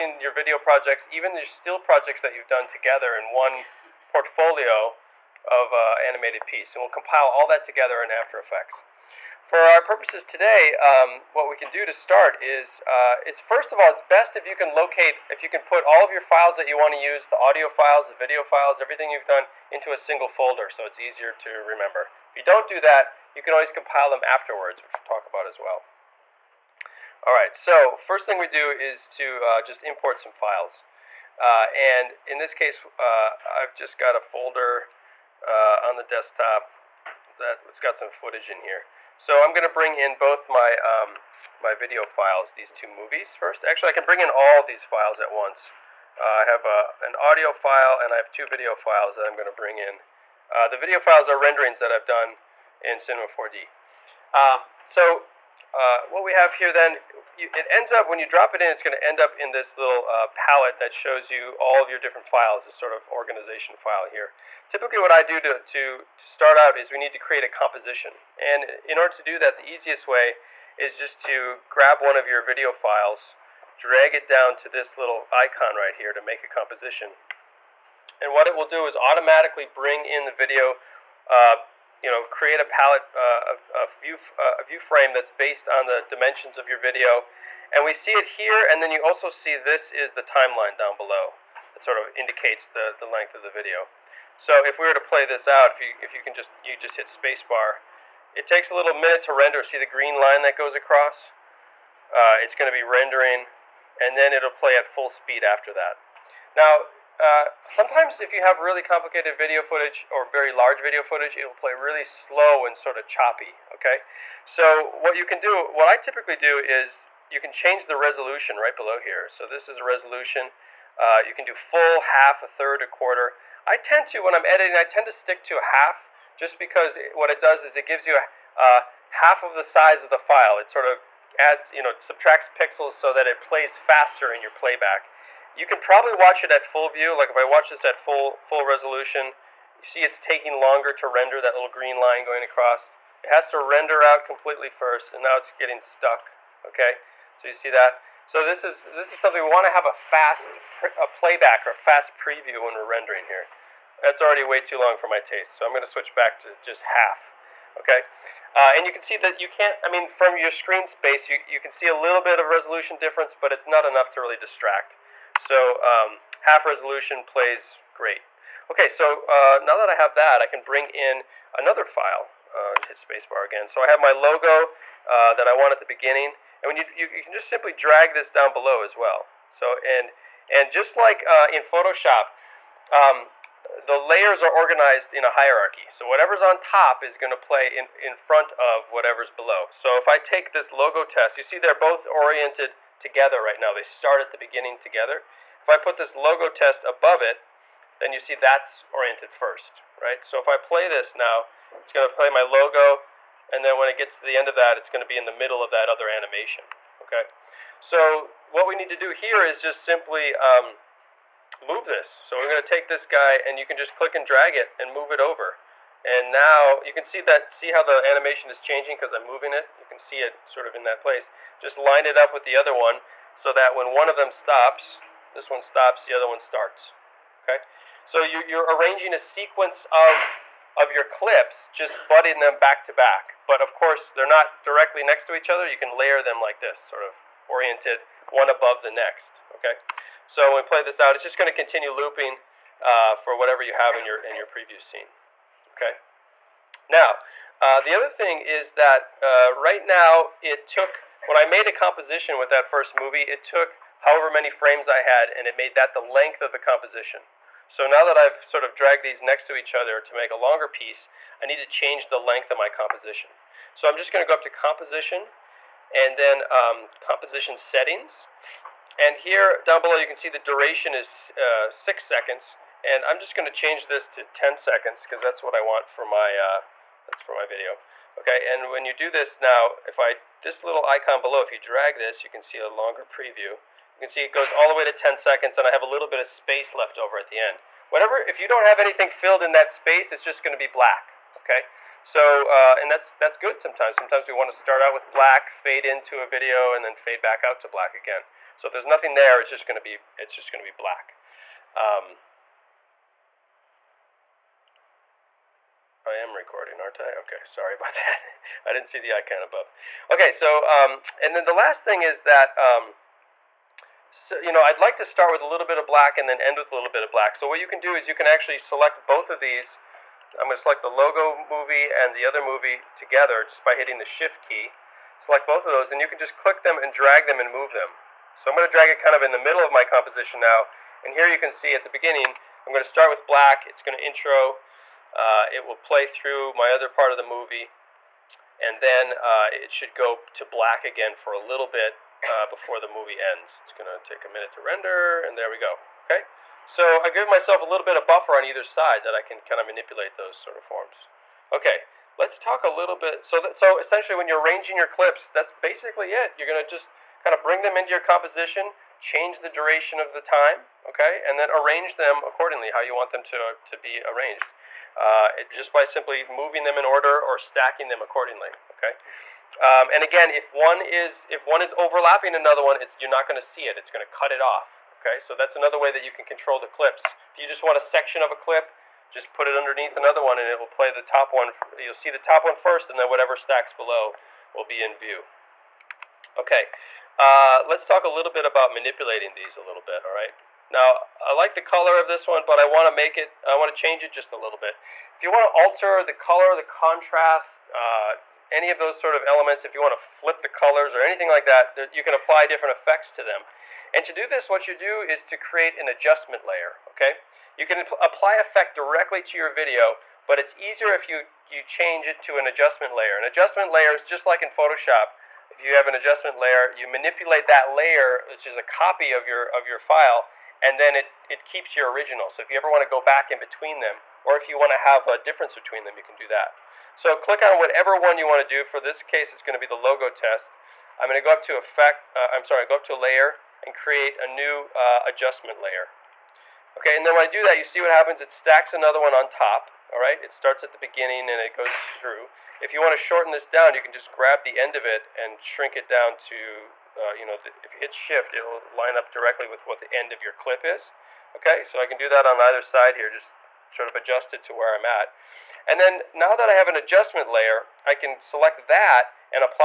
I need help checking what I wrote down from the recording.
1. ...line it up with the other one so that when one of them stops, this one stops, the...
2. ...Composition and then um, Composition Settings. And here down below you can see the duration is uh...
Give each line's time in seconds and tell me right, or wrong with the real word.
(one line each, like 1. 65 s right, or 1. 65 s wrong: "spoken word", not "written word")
1. 221 s right
2. 264 s right.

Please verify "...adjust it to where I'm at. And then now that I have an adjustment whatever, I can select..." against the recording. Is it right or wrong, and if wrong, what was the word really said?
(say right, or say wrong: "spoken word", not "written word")
wrong: "layer", not "whatever".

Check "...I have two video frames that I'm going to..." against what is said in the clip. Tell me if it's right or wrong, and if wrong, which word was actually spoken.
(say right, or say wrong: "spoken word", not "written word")
wrong: "files", not "frames".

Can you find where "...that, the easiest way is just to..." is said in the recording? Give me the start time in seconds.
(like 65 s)
69 s.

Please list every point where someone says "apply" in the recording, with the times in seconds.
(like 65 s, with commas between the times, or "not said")
402 s, 407 s.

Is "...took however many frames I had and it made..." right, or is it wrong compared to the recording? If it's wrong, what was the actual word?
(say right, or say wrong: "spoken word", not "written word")
right.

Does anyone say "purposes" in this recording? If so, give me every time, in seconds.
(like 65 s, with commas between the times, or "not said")
9 s.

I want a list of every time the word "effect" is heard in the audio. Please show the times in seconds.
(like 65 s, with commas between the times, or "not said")
8 s, 402 s, 408 s, 431 s.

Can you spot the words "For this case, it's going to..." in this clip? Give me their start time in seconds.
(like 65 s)
428 s.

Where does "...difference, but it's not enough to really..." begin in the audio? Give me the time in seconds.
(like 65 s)
162 s.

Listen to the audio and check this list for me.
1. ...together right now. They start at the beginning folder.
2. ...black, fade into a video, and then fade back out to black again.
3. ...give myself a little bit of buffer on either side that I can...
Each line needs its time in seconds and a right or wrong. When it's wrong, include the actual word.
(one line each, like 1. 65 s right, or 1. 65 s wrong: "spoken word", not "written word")
1. 192 s wrong: "together", not "folder"
2. 295 s right
3. 347 s right.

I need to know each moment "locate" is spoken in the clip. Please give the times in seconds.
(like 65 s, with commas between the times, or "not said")
14 s.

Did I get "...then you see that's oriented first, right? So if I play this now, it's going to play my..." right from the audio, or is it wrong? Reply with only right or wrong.
right.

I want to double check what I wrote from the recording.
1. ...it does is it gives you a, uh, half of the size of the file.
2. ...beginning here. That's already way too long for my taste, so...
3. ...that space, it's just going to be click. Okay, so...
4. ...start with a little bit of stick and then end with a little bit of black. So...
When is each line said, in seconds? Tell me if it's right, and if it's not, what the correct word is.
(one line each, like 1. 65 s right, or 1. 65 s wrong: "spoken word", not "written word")
1. 127 s right
2. 152 s wrong: "rendering", not "beginning"
3. 289 s wrong: "black", not "click"
4. 315 s wrong: "black", not "stick".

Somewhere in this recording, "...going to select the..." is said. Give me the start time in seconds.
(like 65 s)
320 s.